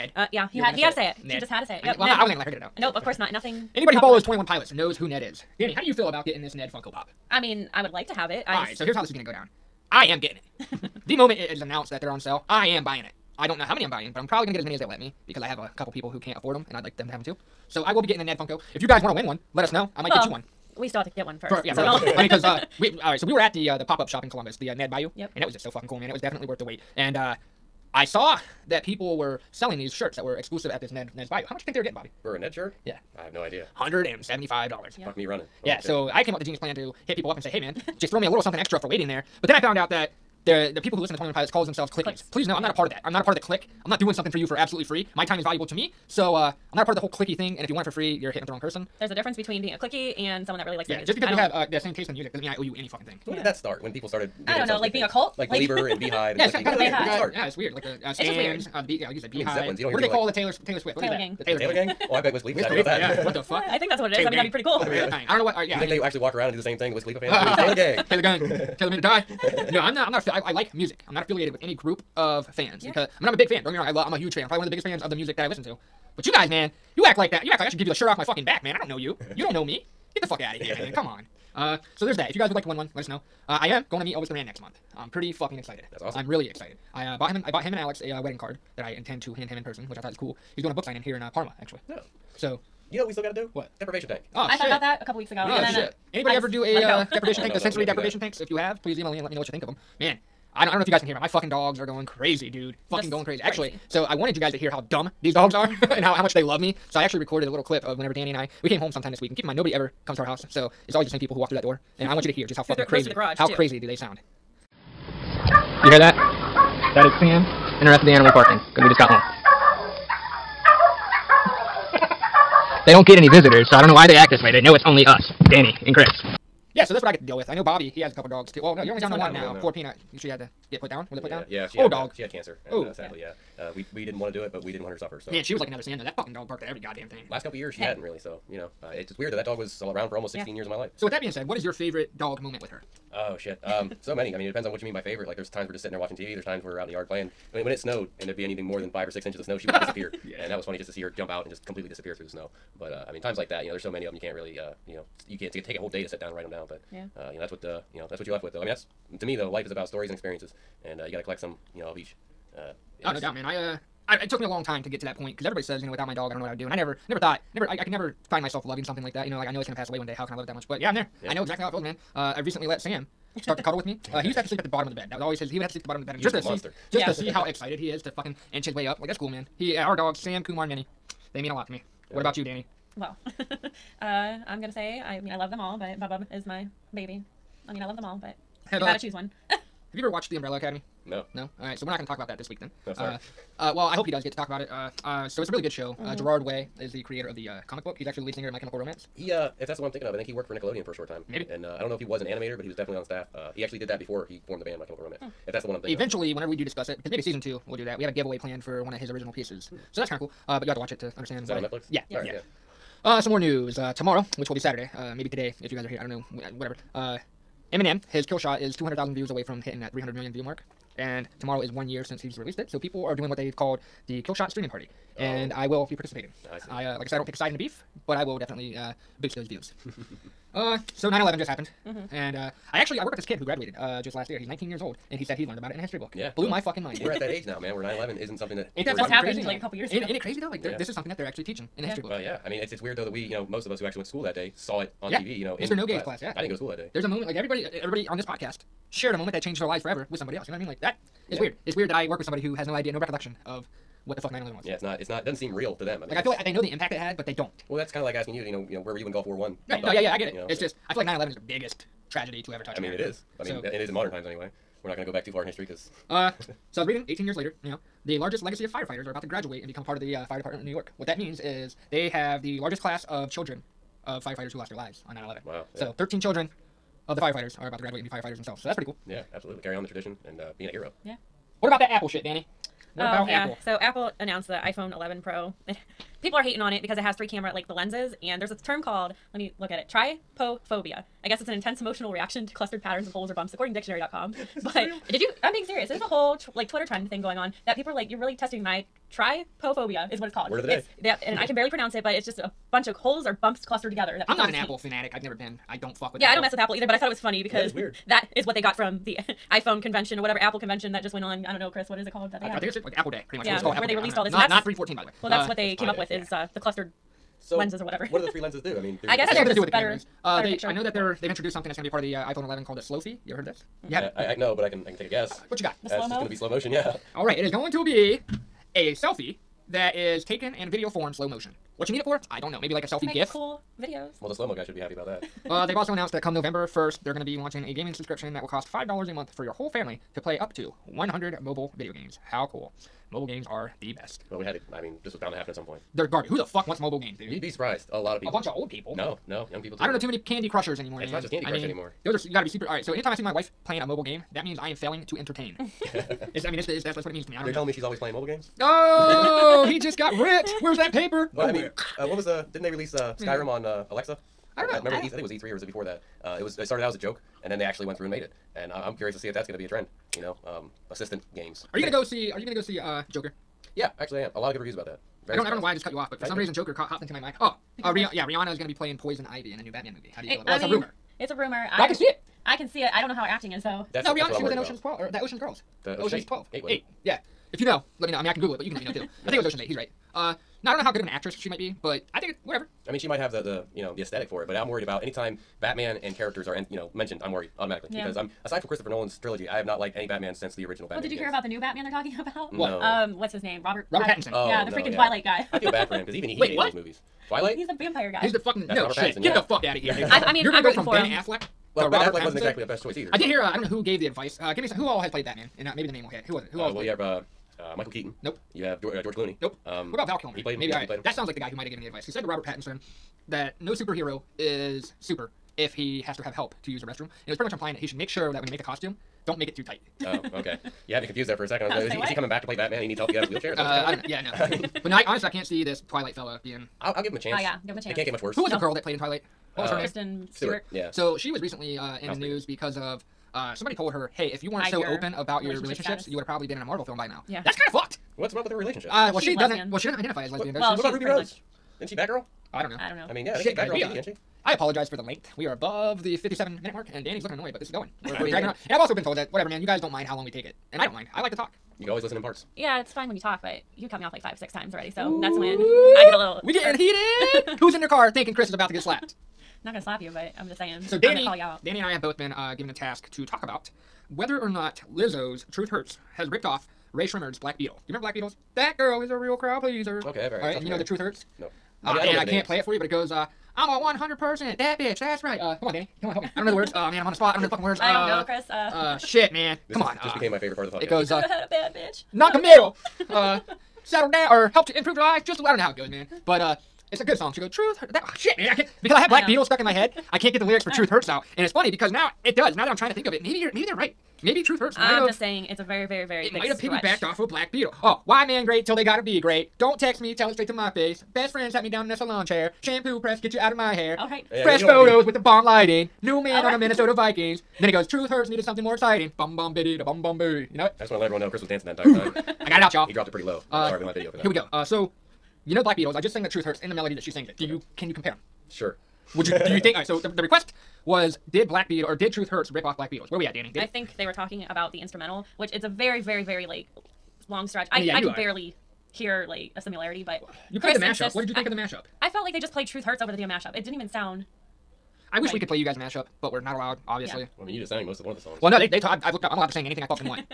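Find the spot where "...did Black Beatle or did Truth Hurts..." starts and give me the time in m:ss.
8:51.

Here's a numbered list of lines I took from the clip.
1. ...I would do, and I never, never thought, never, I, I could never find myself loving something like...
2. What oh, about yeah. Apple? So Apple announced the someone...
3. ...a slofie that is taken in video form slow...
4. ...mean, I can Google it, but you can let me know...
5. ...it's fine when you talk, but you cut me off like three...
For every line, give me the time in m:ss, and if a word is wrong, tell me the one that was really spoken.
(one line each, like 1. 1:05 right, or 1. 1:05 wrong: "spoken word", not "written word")
1. 2:46 right
2. 4:42 wrong: "iPhone", not "someone"
3. 5:28 wrong: "selfie", not "slofie"
4. 6:28 right
5. 7:42 wrong: "five", not "three".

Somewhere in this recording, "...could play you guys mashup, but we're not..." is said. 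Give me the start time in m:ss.
9:05.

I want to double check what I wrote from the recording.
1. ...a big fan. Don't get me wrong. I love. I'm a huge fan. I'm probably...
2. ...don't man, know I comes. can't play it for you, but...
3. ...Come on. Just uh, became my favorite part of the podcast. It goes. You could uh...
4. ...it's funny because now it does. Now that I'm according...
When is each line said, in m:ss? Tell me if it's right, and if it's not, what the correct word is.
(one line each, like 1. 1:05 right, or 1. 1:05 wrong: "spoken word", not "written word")
1. 1:13 right
2. 8:02 wrong: "names", not "comes"
3. 8:09 right
4. 8:21 wrong: "trying", not "according".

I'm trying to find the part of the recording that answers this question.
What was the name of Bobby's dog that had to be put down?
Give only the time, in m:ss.
2:09.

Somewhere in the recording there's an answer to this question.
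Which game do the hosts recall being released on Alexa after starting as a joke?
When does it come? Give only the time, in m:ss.
6:03.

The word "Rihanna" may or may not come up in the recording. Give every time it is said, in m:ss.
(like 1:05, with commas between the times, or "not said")
6:18, 6:24.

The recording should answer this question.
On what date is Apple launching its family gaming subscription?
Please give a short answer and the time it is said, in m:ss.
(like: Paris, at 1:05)
November 1, at 5:36.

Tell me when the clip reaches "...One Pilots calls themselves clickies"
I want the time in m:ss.
0:41.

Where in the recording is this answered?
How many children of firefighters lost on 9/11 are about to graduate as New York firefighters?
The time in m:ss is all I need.
4:35.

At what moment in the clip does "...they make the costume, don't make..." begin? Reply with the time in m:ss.
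7:08.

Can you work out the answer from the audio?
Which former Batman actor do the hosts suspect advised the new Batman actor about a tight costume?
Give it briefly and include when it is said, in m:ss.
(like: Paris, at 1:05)
Val Kilmer, at 7:00.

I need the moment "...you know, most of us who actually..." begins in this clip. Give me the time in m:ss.
4:03.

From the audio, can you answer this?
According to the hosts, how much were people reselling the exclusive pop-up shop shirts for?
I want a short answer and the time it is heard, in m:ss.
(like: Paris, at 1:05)
$175, at 0:33.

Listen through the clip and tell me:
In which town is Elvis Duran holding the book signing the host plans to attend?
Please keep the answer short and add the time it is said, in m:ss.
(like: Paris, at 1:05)
Parma, at 1:31.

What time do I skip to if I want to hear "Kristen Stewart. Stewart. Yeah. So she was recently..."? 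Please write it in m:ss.
7:19.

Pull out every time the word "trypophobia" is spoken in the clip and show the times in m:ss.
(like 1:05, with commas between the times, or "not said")
4:49, 4:59.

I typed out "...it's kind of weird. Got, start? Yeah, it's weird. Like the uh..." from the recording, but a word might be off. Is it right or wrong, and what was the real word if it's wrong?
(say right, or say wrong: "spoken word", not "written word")
right.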